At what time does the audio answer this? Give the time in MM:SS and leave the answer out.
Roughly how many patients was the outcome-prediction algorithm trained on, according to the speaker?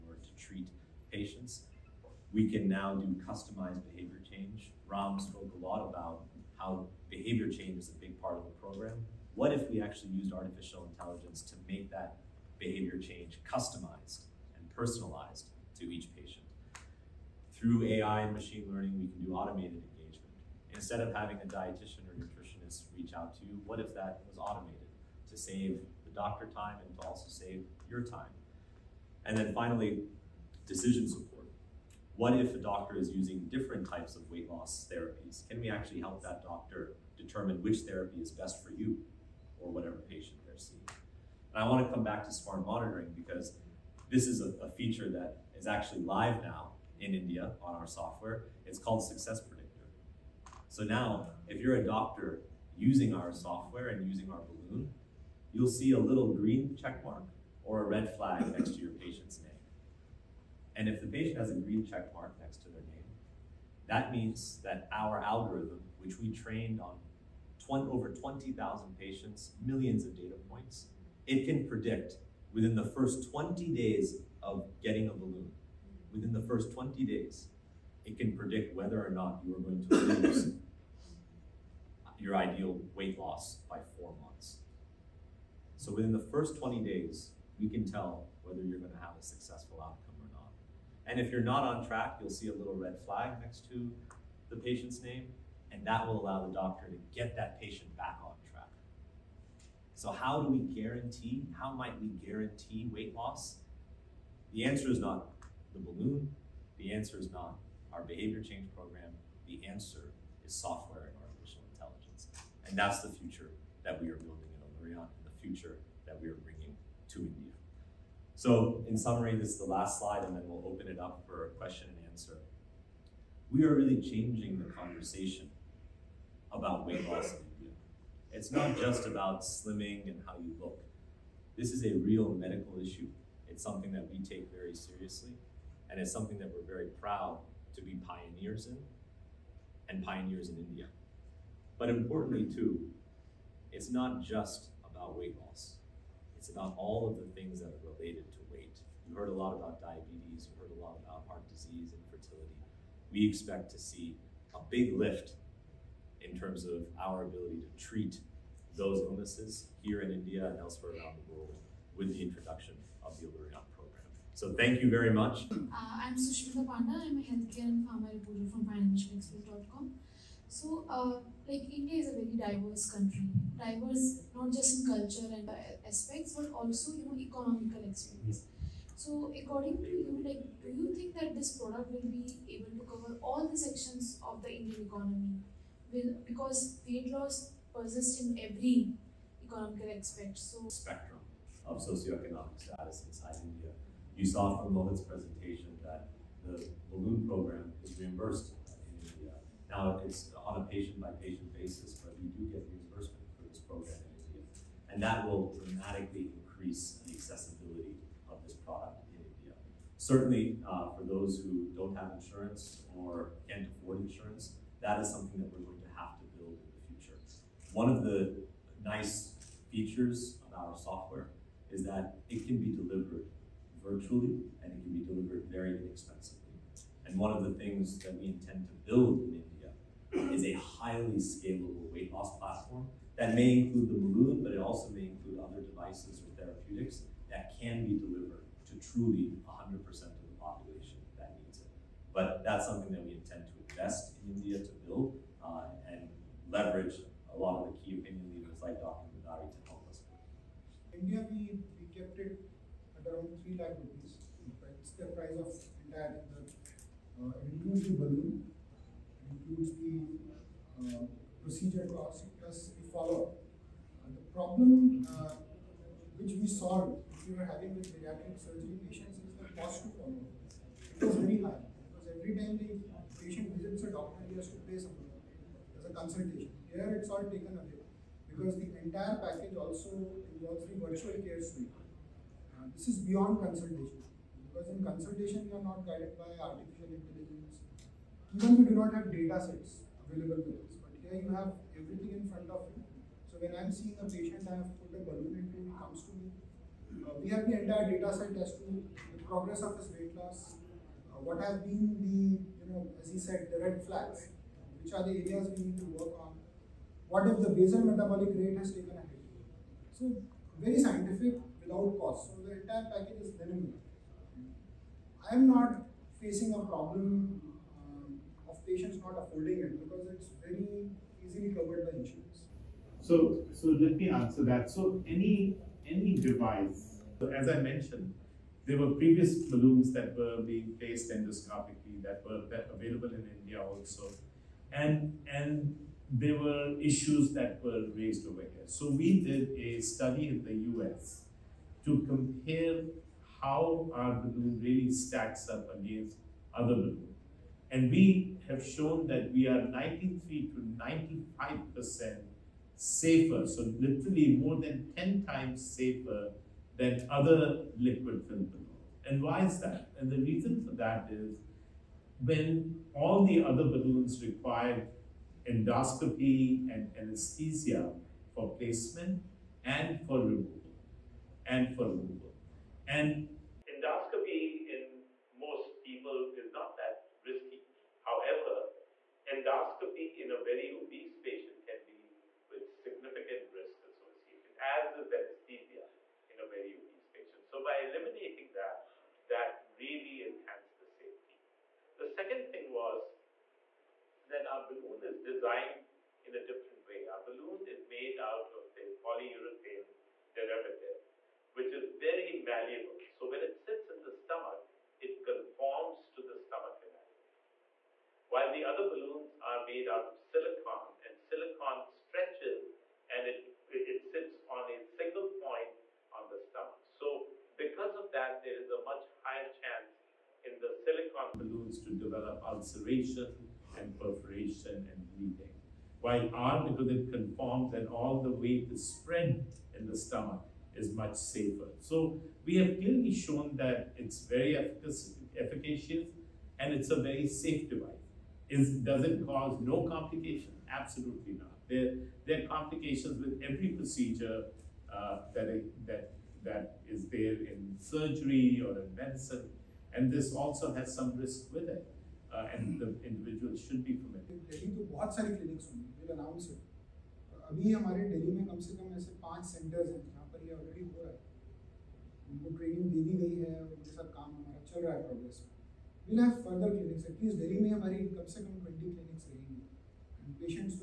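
01:07.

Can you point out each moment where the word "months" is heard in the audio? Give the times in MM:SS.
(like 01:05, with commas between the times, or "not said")
01:24.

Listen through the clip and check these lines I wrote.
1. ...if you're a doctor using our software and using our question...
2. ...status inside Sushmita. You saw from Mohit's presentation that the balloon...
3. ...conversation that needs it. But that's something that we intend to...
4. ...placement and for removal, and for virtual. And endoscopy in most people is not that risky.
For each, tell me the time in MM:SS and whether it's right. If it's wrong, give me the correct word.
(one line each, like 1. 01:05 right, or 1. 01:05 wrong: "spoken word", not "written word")
1. 00:51 wrong: "balloon", not "question"
2. 03:12 wrong: "India", not "Sushmita"
3. 04:00 wrong: "population", not "conversation"
4. 06:08 wrong: "removal", not "virtual".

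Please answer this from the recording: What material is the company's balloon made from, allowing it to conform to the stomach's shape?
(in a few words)
Polyurethane derivative.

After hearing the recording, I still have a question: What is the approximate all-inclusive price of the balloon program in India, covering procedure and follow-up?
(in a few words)
3 lakh rupees.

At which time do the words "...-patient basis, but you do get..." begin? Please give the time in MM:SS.
03:21.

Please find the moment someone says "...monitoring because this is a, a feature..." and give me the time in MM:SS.
00:42.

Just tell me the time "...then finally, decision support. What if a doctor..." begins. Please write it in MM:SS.
00:29.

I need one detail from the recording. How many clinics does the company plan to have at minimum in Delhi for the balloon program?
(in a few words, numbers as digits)
20.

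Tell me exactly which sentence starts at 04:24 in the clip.
the problem uh, which we solved we were having with bariatric surgery patients is the cost to follow.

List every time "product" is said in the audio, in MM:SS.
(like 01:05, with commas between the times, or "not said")
03:01, 03:28.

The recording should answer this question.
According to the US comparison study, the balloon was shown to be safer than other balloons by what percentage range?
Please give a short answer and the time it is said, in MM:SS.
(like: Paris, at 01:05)
93 to 95%, at 05:49.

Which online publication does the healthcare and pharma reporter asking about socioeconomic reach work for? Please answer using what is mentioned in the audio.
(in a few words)
financialexpress.com.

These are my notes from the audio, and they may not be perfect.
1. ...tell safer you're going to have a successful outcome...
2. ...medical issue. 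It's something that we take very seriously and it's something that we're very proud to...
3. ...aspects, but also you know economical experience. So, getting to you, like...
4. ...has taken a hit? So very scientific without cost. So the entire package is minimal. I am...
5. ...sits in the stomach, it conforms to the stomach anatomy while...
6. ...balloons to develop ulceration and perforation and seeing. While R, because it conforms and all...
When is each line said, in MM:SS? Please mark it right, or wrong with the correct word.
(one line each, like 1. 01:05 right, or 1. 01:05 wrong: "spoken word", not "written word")
1. 01:27 wrong: "whether", not "safer"
2. 02:12 right
3. 02:55 wrong: "according", not "getting"
4. 05:08 right
5. 06:43 right
6. 07:01 wrong: "bleeding", not "seeing".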